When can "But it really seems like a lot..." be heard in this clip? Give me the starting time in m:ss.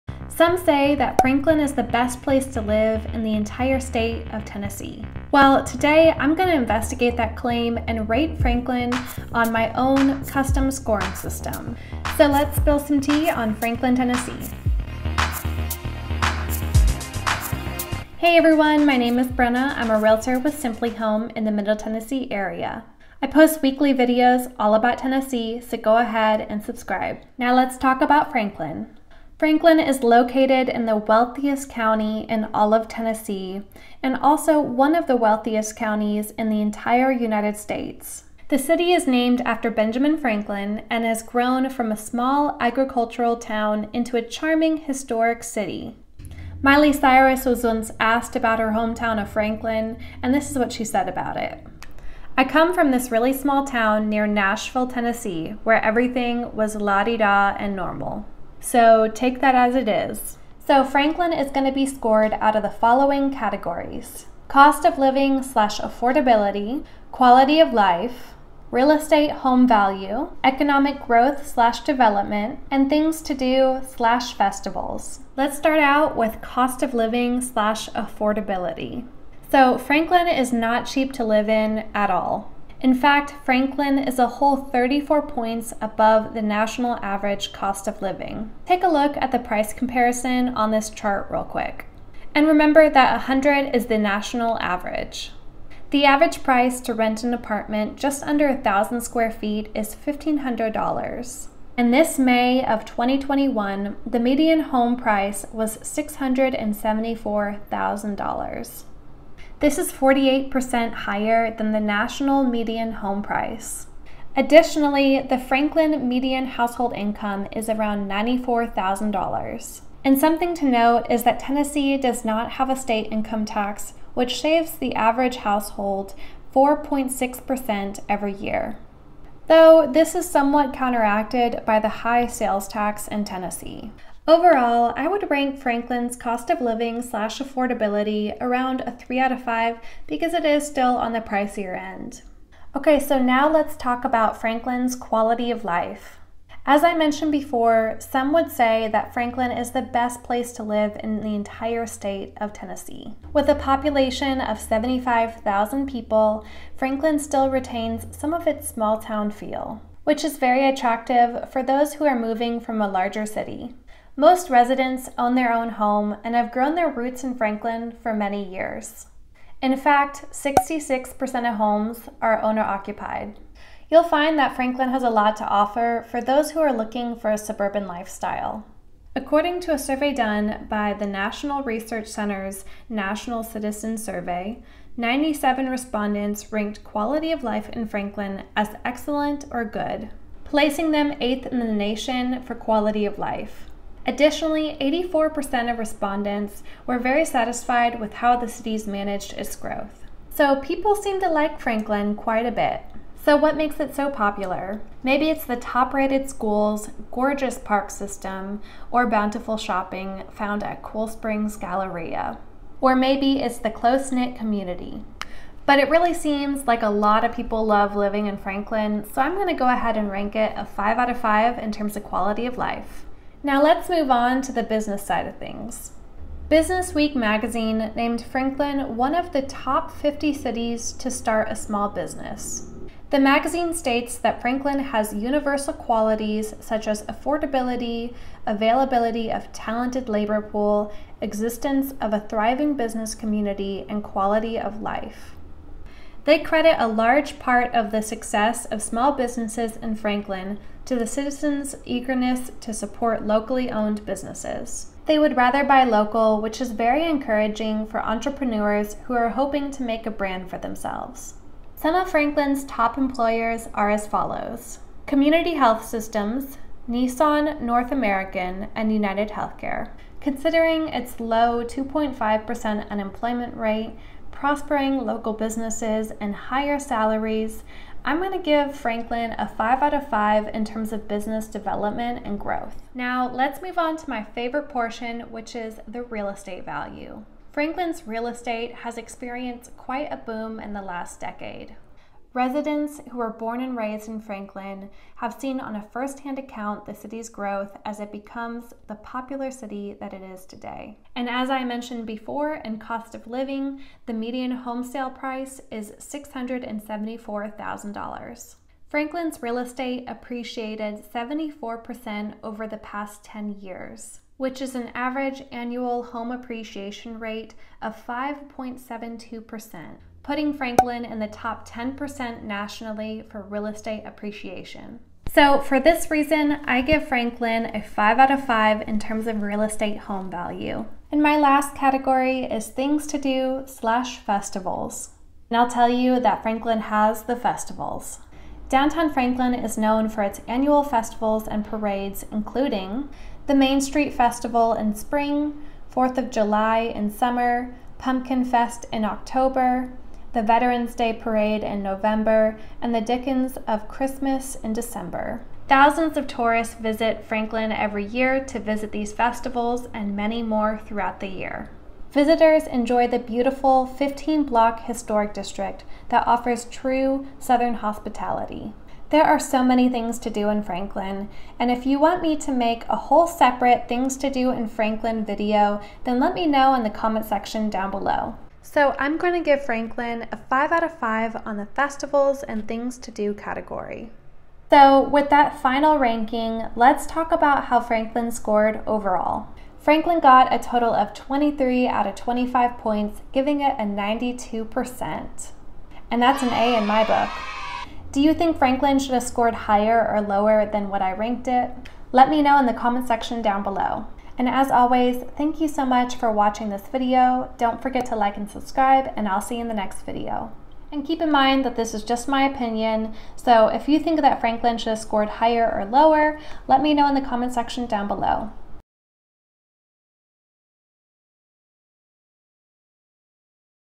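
3:35.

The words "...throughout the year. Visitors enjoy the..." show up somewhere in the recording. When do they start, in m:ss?
6:00.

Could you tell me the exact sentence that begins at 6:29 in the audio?
Franklin got a total of 23 out of 25 points, giving it a 92%.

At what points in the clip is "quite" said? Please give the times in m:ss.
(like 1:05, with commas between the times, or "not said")
3:22, 4:49.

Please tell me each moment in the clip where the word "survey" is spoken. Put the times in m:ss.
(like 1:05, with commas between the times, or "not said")
2:59, 3:03.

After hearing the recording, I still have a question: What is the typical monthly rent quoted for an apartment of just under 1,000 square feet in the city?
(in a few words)
$1,500.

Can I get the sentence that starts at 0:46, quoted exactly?
Miley Cyrus was once asked about her hometown of Franklin, and this is what she said about it.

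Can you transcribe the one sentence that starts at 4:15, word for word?
They would rather buy local, which is very encouraging for entrepreneurs who are hoping to make a brand for themselves.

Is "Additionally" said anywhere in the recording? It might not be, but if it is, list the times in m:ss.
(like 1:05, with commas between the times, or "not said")
1:54, 3:14.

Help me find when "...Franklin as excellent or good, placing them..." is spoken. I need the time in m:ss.
3:07.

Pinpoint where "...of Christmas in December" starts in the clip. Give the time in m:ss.
5:53.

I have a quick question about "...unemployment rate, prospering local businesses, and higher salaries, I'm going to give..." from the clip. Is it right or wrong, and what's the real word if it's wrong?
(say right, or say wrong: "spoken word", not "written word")
right.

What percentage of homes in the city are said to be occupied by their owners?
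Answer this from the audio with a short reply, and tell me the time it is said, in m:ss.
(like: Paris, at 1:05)
66%, at 2:50.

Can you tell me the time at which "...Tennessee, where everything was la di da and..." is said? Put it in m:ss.
0:54.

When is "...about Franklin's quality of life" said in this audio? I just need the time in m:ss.
2:24.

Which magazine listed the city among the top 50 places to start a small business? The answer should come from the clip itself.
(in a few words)
Business Week.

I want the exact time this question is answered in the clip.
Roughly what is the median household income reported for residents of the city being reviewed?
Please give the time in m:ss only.
1:58.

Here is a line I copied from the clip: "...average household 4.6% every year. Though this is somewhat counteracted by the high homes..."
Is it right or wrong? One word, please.
wrong.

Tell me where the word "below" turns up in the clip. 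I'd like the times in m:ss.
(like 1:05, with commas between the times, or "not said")
6:17, 6:43, 6:58.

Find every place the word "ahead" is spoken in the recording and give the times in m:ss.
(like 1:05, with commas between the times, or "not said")
0:25, 3:39.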